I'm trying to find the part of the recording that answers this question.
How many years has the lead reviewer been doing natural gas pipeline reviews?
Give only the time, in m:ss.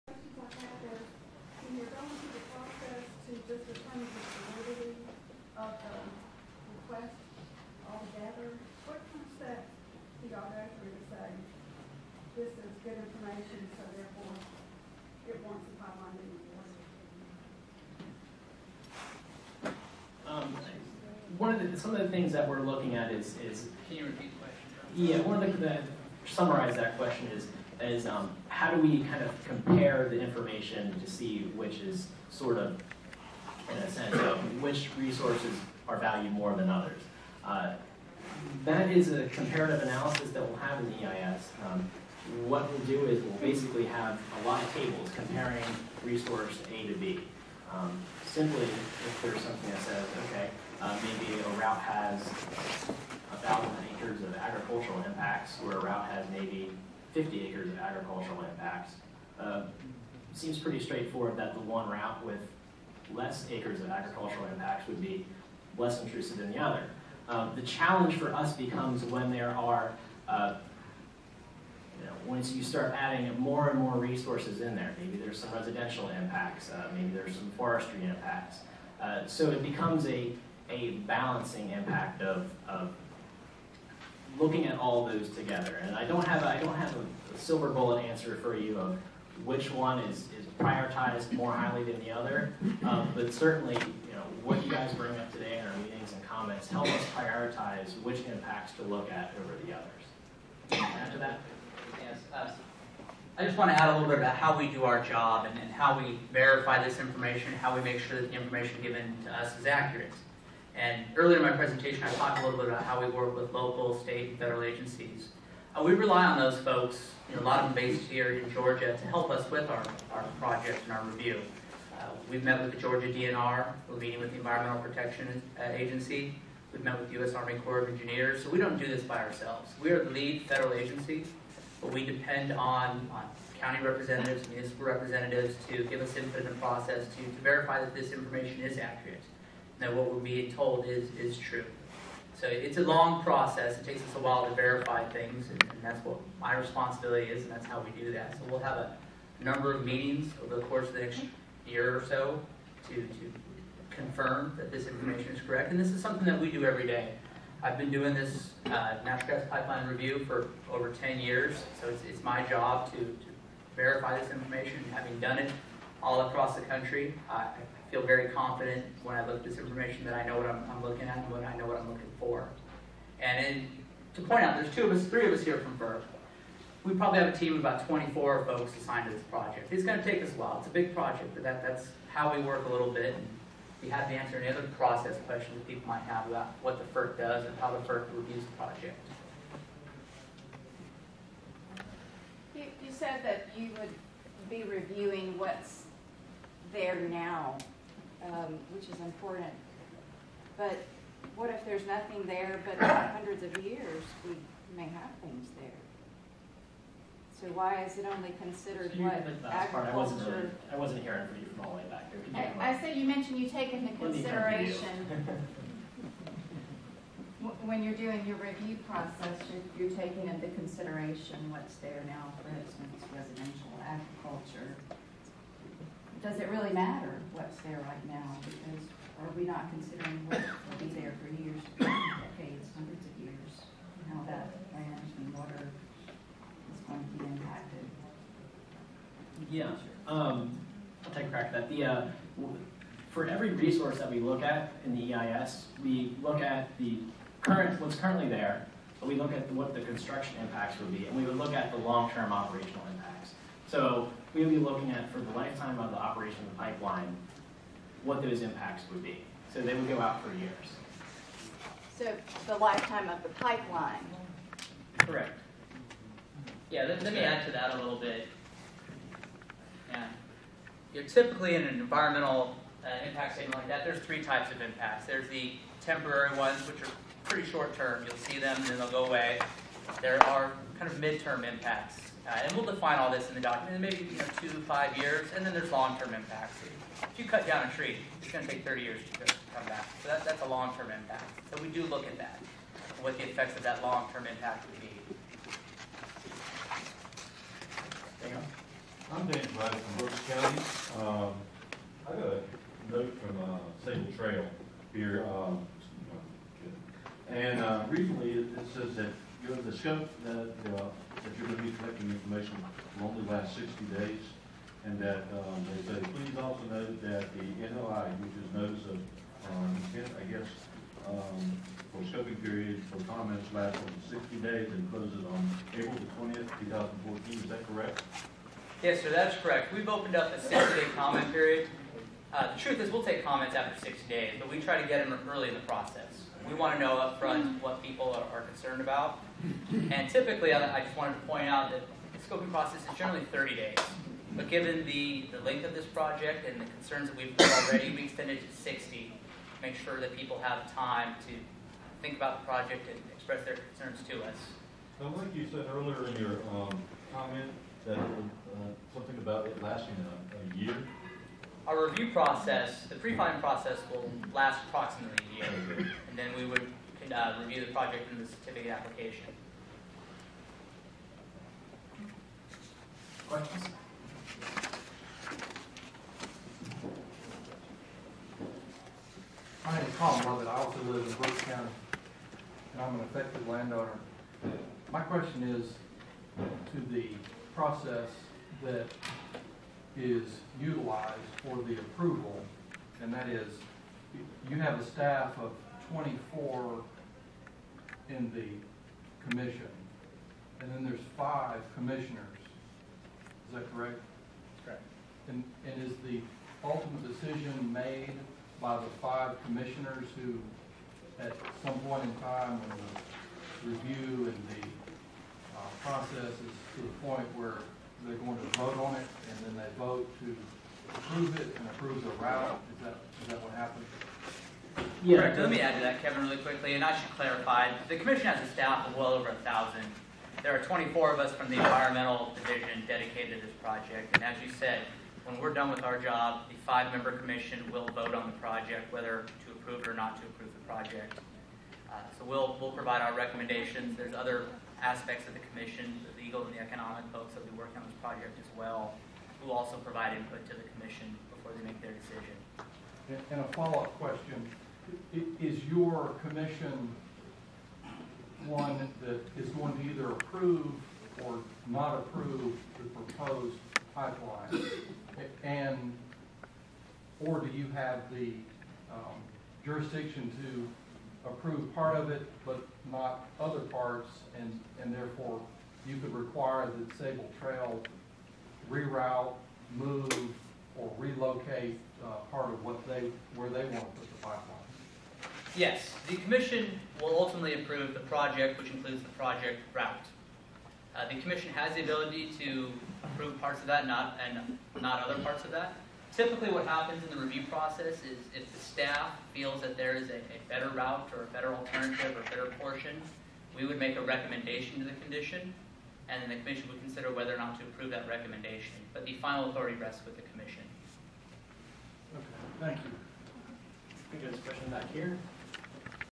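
2:40.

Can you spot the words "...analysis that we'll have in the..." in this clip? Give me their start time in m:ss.
0:39.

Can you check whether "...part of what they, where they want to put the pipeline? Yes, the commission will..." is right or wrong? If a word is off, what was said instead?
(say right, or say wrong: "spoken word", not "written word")
right.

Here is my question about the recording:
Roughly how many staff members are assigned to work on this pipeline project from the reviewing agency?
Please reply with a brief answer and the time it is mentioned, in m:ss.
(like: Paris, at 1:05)
about 24, at 2:57.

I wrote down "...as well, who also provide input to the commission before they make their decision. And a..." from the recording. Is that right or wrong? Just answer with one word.
right.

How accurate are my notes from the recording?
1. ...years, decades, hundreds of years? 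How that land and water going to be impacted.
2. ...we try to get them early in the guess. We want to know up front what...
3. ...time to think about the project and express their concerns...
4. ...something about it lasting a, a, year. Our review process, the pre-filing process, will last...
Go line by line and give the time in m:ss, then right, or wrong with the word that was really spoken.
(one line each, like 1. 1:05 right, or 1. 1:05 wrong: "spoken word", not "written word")
1. 3:51 right
2. 5:34 wrong: "process", not "guess"
3. 5:50 right
4. 5:58 right.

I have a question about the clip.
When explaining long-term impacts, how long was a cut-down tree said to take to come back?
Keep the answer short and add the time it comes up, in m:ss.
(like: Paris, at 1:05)
30 years, at 4:48.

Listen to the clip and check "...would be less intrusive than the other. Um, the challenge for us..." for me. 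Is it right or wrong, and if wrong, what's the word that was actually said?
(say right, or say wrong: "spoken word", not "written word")
right.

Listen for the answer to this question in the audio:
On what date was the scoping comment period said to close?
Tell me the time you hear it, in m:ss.
5:25.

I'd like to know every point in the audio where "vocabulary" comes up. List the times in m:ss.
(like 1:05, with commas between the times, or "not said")
not said.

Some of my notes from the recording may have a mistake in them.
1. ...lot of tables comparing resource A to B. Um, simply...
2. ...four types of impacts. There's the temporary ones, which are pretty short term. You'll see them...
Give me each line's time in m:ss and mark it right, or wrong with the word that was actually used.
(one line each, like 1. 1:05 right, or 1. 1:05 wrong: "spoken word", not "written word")
1. 0:44 right
2. 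4:33 wrong: "three", not "four".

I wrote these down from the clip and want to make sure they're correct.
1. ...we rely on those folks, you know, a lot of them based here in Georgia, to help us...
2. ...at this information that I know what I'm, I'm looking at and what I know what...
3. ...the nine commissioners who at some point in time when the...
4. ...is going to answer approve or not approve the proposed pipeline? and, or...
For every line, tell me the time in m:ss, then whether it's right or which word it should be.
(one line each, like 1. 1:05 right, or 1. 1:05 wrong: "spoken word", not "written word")
1. 1:55 right
2. 2:49 right
3. 6:48 wrong: "five", not "nine"
4. 7:39 wrong: "either", not "answer".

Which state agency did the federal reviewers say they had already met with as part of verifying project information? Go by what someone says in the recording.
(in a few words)
Georgia DNR.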